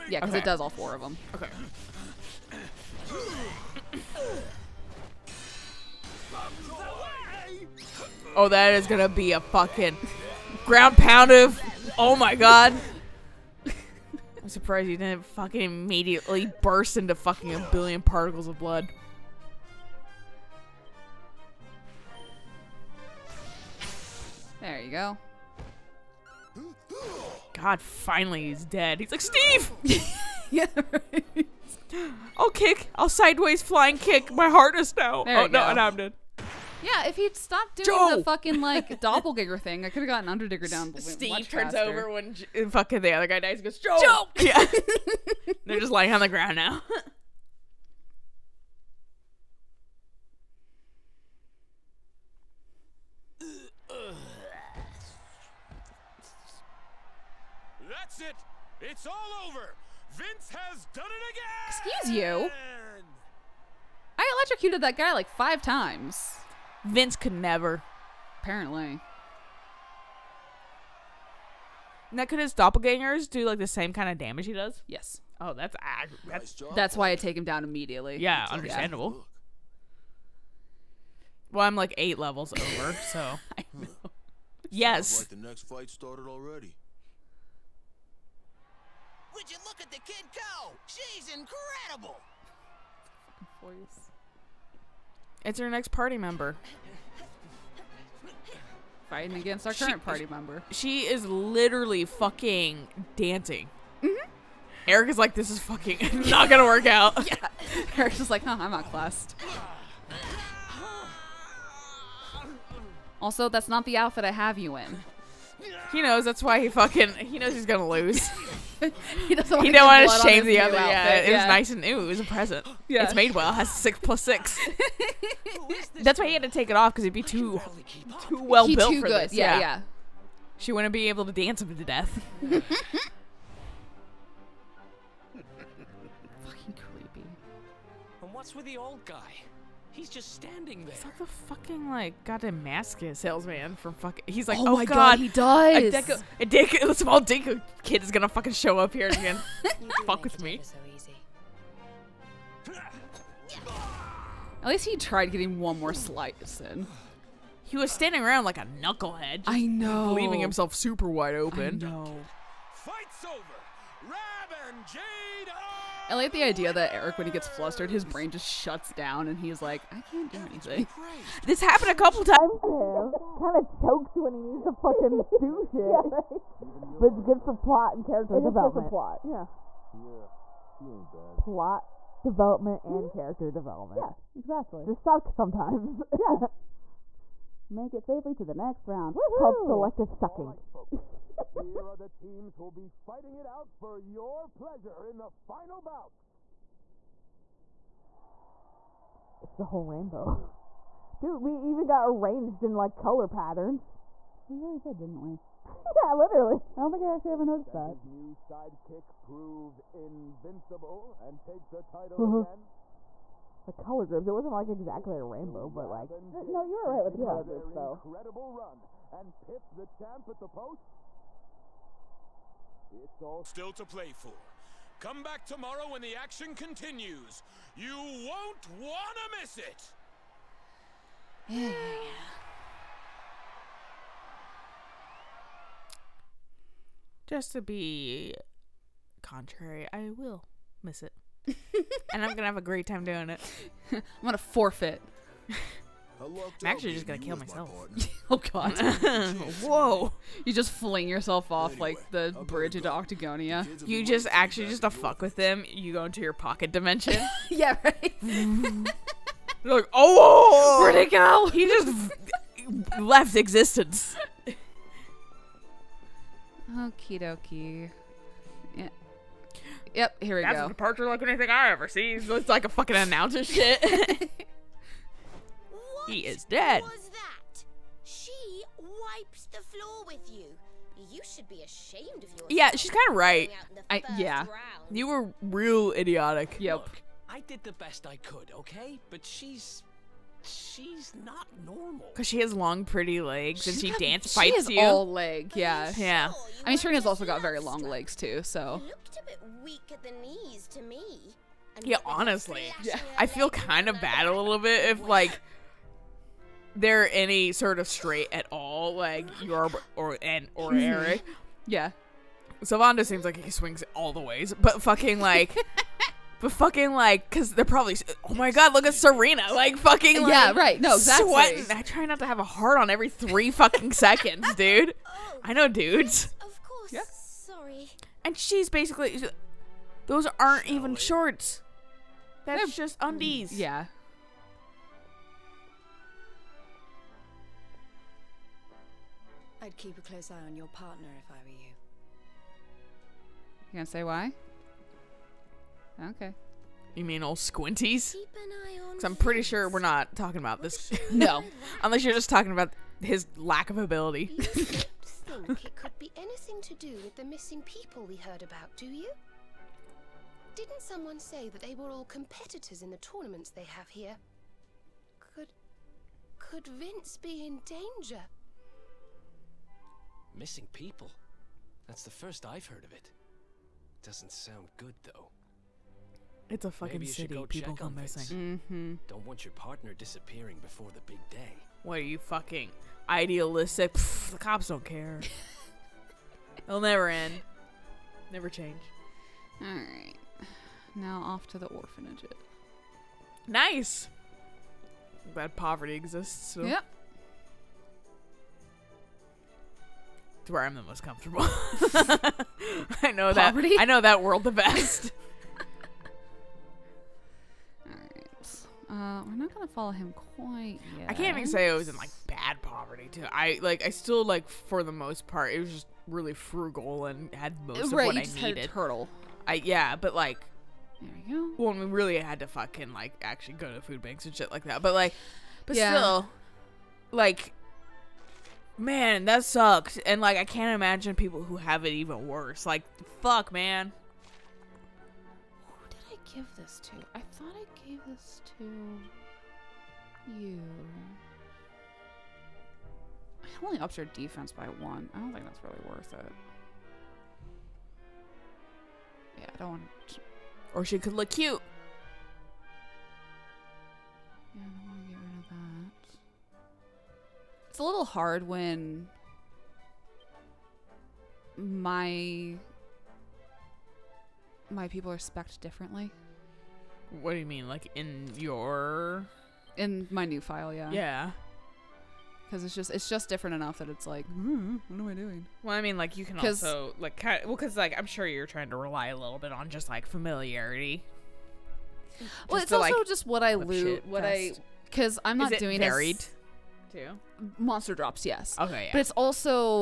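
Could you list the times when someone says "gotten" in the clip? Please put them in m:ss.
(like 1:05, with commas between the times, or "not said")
0:40.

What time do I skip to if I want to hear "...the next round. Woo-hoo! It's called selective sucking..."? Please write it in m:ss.
3:08.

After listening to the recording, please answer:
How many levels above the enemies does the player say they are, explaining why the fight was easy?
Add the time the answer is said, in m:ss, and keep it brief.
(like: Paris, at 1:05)
8, at 1:21.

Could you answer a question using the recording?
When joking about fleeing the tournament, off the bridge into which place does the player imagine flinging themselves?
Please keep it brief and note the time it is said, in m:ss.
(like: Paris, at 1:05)
Octagonia, at 4:12.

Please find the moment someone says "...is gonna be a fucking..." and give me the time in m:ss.
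0:08.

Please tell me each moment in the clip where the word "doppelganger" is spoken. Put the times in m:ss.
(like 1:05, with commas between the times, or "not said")
0:38, 1:12.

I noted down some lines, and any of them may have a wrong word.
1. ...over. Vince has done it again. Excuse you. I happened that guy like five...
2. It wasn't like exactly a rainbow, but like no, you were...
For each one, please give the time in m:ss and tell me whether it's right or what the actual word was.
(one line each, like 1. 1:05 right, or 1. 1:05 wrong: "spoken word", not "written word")
1. 0:59 wrong: "electrocuted", not "happened"
2. 3:34 right.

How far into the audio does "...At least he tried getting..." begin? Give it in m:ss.
2:34.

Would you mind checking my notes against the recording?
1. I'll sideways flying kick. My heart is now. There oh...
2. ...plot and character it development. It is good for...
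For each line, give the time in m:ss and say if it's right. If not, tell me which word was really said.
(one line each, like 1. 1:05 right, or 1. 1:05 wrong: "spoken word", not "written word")
1. 0:32 right
2. 2:57 right.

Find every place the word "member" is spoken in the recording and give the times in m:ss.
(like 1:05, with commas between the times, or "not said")
1:36, 1:40.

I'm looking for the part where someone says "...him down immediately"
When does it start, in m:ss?
1:17.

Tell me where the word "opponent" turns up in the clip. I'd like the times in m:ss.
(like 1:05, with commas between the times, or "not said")
not said.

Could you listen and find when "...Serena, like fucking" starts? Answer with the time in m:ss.
5:18.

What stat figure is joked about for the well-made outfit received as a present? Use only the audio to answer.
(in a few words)
six plus six.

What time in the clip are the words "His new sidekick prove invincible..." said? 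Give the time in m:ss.
3:27.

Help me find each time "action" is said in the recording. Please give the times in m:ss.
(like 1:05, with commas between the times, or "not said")
3:46.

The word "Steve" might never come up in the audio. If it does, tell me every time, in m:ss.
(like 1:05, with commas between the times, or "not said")
0:29, 0:40.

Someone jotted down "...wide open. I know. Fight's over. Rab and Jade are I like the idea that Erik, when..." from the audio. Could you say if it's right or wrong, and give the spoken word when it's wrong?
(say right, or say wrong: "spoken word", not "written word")
right.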